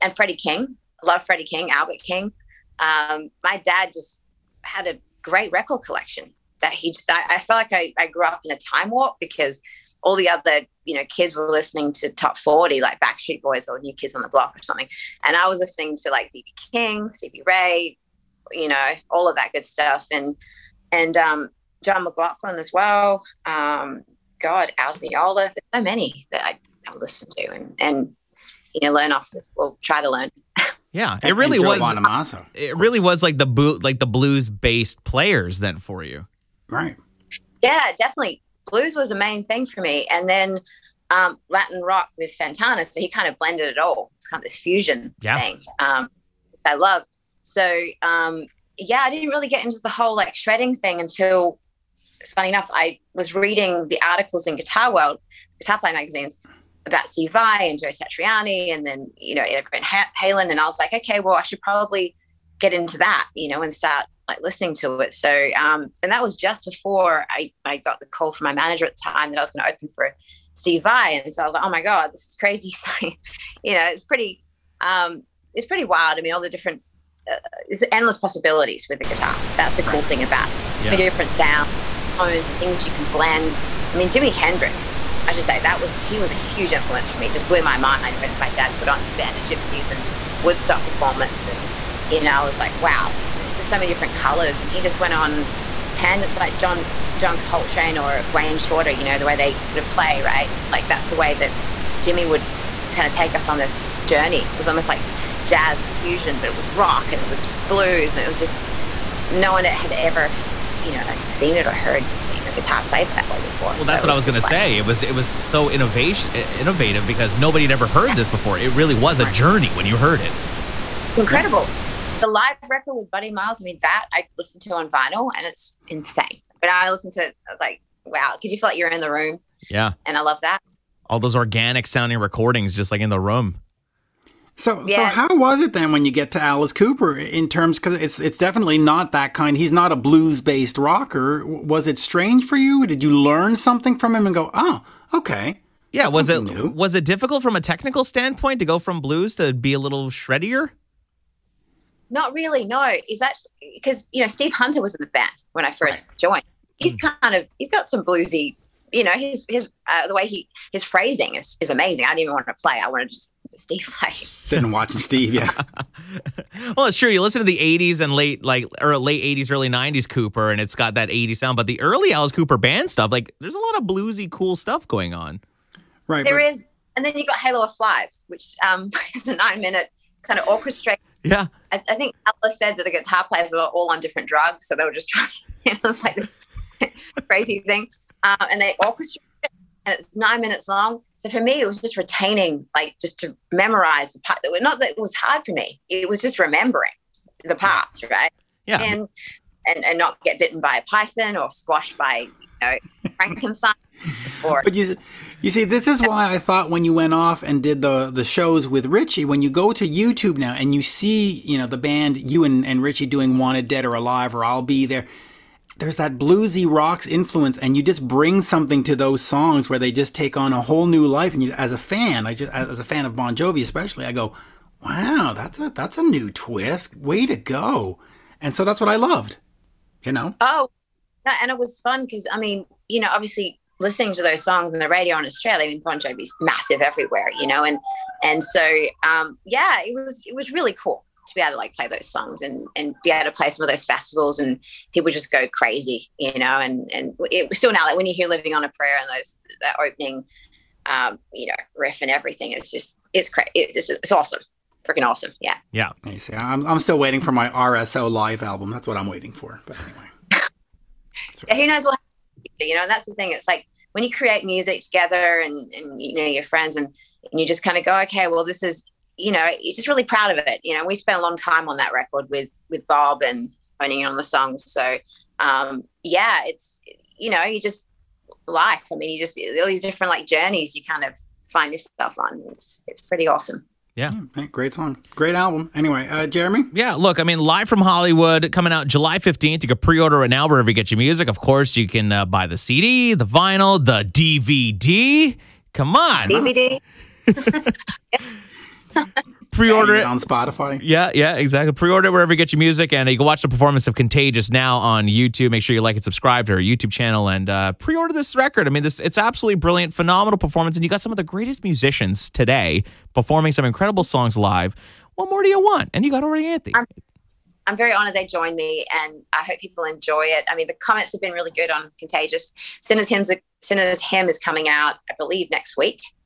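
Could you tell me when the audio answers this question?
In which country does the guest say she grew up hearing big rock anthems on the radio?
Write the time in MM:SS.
03:55.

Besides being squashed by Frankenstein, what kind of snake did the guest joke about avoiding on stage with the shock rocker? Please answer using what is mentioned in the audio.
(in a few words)
python.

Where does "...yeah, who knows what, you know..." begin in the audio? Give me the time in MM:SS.
04:21.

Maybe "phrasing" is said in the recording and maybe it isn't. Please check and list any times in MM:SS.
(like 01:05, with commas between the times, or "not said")
02:40.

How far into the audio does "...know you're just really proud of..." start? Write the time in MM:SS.
04:29.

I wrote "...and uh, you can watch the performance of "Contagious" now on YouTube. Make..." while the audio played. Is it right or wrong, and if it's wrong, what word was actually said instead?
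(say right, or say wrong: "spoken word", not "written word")
right.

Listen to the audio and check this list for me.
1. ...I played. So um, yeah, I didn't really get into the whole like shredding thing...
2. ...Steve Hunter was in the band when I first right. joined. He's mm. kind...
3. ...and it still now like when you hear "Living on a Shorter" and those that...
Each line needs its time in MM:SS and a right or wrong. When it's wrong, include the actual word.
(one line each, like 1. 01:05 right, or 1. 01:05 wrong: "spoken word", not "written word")
1. 00:46 wrong: "loved", not "played"
2. 02:34 right
3. 04:06 wrong: "Prayer", not "Shorter".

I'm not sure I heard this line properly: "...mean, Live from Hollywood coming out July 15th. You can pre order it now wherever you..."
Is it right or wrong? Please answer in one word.
right.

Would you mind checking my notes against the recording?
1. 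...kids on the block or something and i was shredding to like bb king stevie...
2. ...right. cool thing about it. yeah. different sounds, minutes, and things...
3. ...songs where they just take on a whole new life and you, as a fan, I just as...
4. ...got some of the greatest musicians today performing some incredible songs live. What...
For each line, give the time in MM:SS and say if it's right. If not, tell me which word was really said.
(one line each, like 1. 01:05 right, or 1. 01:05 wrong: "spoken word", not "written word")
1. 00:13 wrong: "listening", not "shredding"
2. 01:19 wrong: "tones", not "minutes"
3. 03:39 right
4. 05:10 right.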